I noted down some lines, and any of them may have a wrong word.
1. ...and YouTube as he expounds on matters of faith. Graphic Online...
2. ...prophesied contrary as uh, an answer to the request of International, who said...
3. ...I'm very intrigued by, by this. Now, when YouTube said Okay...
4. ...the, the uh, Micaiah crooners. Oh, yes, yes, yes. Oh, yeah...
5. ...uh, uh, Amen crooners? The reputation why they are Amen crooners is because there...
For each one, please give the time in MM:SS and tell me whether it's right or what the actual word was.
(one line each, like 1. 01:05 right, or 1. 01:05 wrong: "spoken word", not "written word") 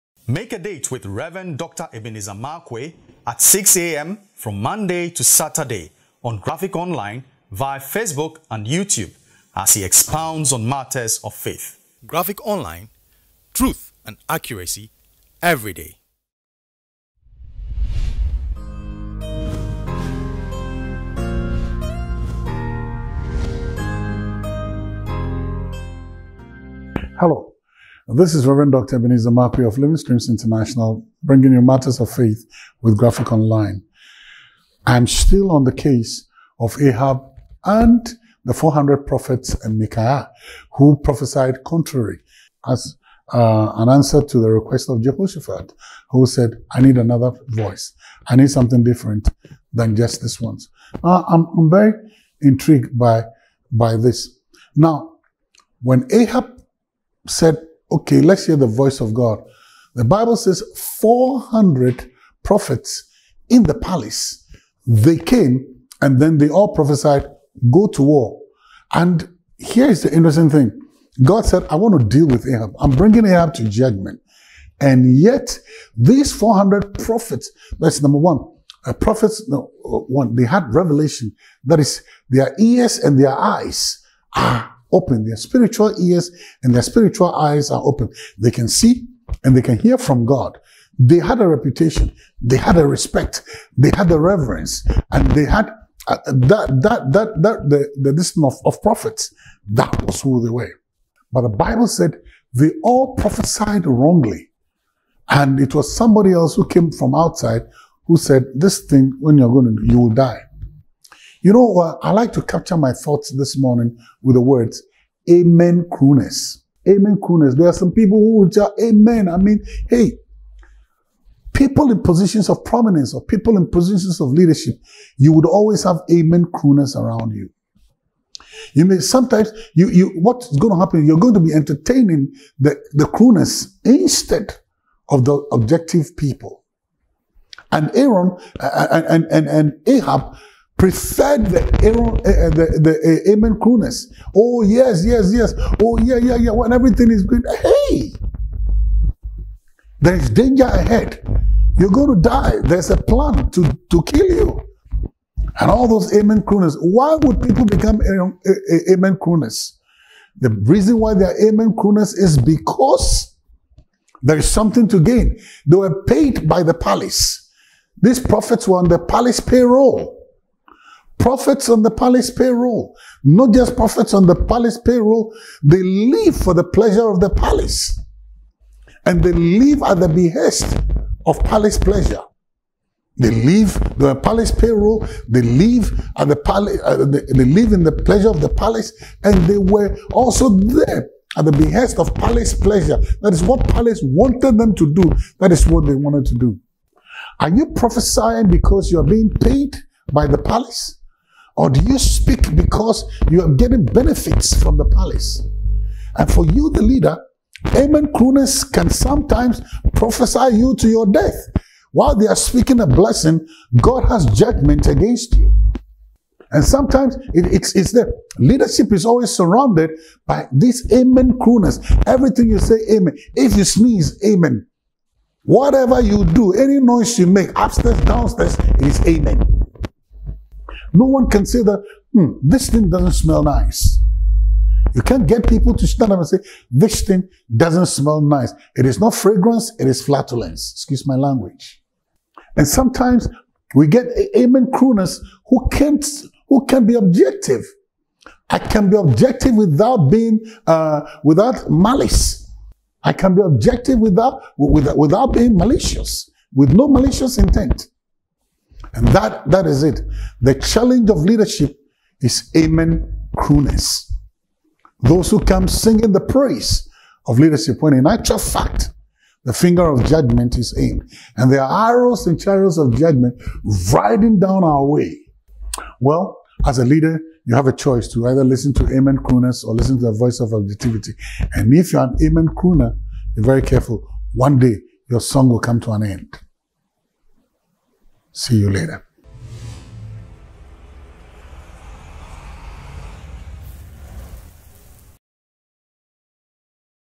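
1. 00:08 right
2. 00:41 wrong: "Jehoshaphat", not "International"
3. 00:51 wrong: "Ahab", not "YouTube"
4. 02:22 wrong: "Amen", not "Micaiah"
5. 02:38 wrong: "reason", not "reputation".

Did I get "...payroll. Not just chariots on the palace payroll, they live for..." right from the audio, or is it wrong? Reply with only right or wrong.
wrong.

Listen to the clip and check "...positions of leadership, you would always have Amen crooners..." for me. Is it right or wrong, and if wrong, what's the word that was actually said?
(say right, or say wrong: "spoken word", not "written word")
right.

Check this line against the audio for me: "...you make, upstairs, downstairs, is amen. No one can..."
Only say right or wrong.
right.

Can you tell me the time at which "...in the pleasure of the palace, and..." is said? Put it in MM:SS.
03:07.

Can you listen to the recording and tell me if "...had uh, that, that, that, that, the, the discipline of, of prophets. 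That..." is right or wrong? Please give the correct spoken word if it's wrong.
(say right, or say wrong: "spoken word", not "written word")
right.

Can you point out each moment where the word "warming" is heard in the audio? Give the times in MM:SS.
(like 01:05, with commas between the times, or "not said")
not said.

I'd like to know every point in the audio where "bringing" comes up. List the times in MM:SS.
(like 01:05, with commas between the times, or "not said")
00:31, 01:12.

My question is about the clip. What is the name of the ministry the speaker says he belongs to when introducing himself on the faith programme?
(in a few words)
Living Streams International.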